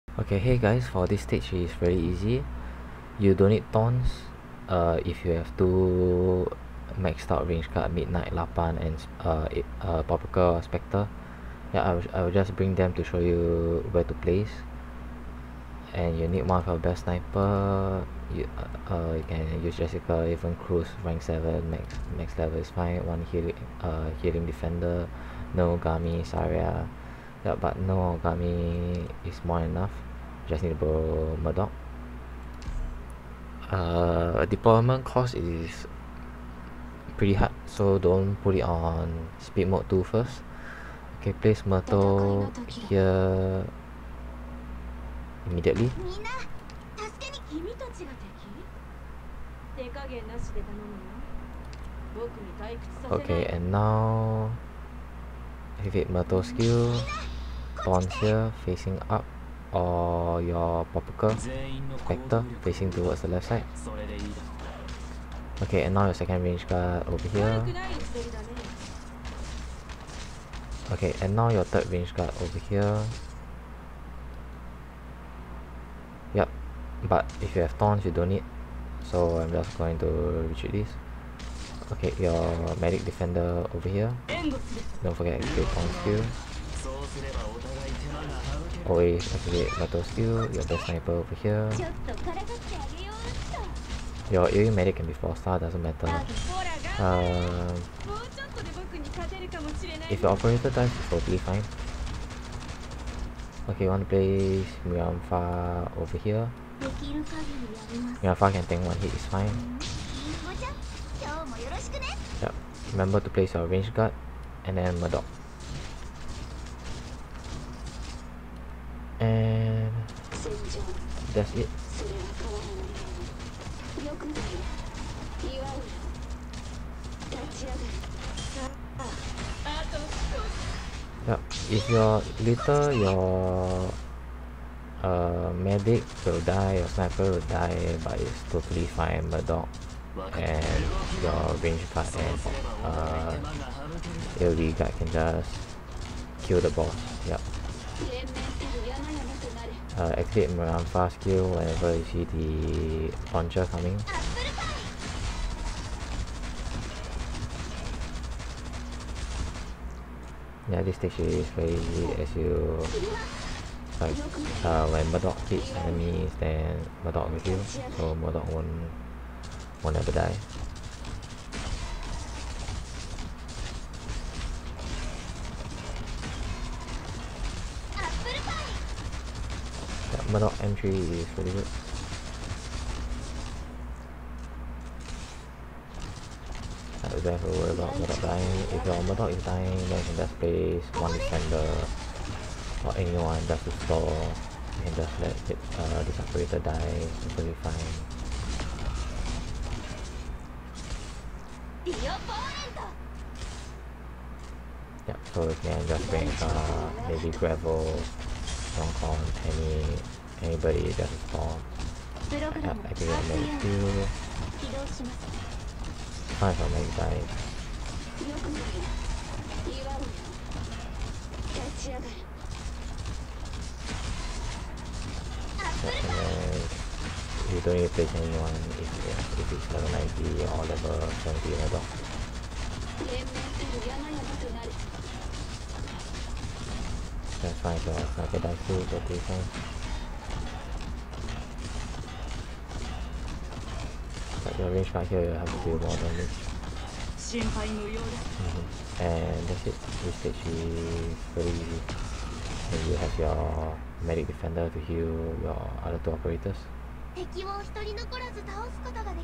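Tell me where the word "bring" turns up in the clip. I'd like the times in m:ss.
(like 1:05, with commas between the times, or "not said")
0:12, 3:26.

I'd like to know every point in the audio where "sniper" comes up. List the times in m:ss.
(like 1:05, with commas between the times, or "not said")
0:17, 1:30, 2:16.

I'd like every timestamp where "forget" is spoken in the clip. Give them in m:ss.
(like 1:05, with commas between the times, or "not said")
1:25.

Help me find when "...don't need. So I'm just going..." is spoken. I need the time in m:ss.
1:18.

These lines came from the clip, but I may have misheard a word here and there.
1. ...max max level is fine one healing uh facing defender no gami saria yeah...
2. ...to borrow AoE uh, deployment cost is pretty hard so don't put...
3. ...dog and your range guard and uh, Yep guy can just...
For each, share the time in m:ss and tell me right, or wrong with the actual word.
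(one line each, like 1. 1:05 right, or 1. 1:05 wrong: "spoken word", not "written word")
1. 0:21 wrong: "healing", not "facing"
2. 0:30 wrong: "Mudrock", not "AoE"
3. 2:19 wrong: "AoE", not "Yep".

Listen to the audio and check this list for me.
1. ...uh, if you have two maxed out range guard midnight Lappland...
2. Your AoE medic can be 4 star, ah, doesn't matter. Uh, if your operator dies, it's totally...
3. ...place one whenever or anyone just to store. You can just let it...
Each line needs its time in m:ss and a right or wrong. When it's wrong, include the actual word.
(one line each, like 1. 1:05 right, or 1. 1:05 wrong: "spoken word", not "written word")
1. 0:04 right
2. 1:34 right
3. 3:10 wrong: "defender", not "whenever".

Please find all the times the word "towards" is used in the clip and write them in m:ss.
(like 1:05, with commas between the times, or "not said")
1:02.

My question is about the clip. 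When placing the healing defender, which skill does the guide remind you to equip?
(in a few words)
thorn skill.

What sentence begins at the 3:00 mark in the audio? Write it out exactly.
That middle entry is really good.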